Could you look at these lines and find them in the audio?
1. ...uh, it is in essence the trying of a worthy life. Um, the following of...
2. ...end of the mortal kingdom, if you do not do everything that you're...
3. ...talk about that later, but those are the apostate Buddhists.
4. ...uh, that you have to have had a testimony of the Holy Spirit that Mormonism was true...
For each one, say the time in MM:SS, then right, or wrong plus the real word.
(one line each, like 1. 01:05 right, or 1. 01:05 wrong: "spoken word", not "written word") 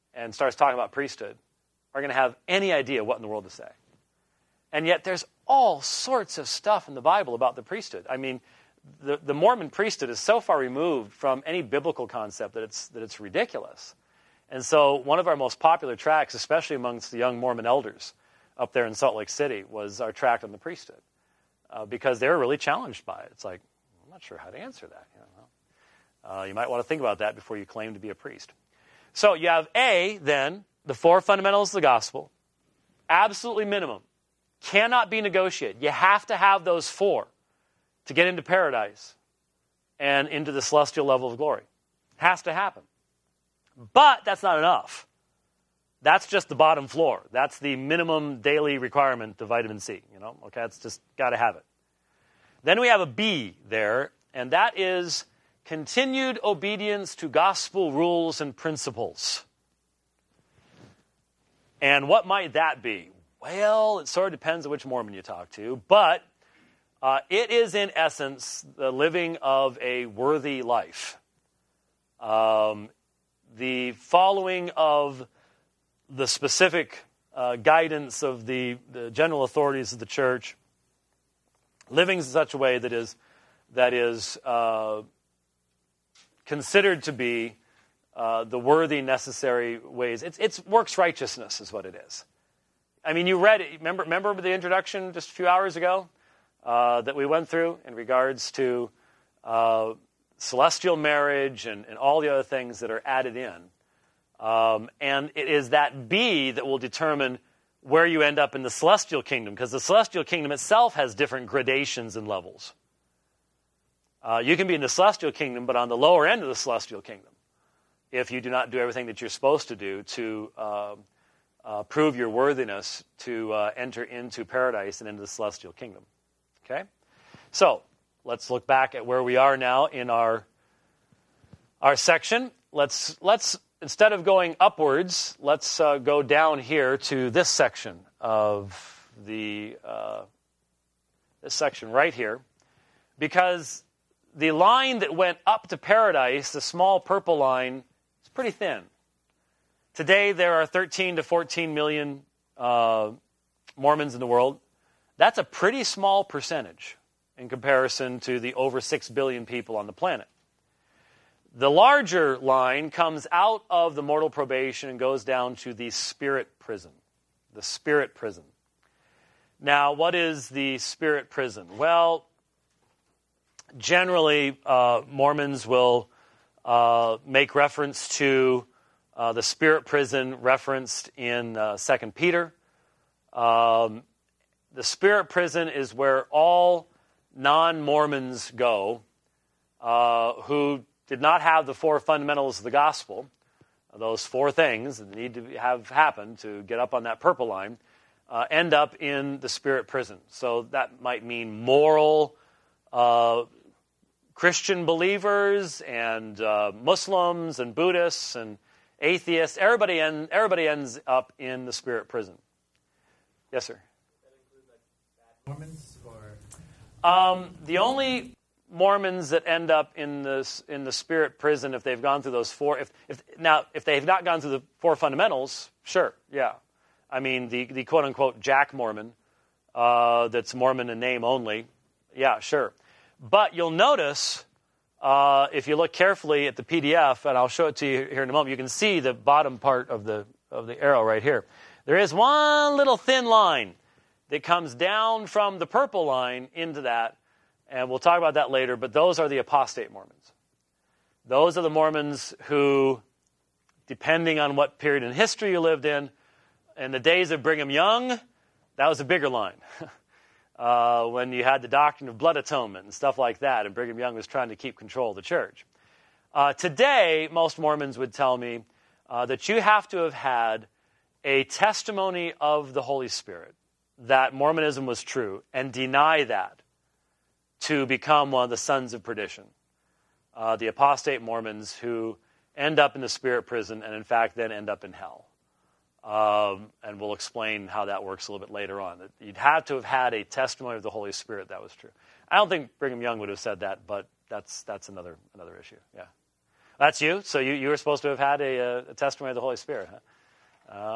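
1. 01:06 wrong: "living", not "trying"
2. 01:56 wrong: "celestial", not "mortal"
3. 04:07 wrong: "Mormons", not "Buddhists"
4. 04:29 right.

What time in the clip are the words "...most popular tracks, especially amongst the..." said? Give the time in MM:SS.
00:15.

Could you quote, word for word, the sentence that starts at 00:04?
And yet, there's all sorts of stuff in the Bible about the priesthood.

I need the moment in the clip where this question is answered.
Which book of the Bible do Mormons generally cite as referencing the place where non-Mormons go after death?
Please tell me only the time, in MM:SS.
03:01.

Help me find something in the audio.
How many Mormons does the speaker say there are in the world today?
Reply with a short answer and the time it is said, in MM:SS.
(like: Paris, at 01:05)
13 to 14 million, at 02:30.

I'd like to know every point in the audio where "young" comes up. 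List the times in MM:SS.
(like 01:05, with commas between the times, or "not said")
00:17, 04:17, 04:23, 04:52.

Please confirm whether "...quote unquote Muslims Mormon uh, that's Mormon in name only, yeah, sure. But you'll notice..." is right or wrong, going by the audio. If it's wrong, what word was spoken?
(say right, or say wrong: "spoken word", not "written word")
wrong: "Jack", not "Muslims".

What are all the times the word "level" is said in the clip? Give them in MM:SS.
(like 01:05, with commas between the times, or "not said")
00:41, 01:52.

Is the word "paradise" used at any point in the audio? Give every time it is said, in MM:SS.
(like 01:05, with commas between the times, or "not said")
00:38, 02:04, 02:25.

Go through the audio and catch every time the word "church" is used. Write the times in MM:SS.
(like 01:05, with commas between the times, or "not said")
01:20, 04:25.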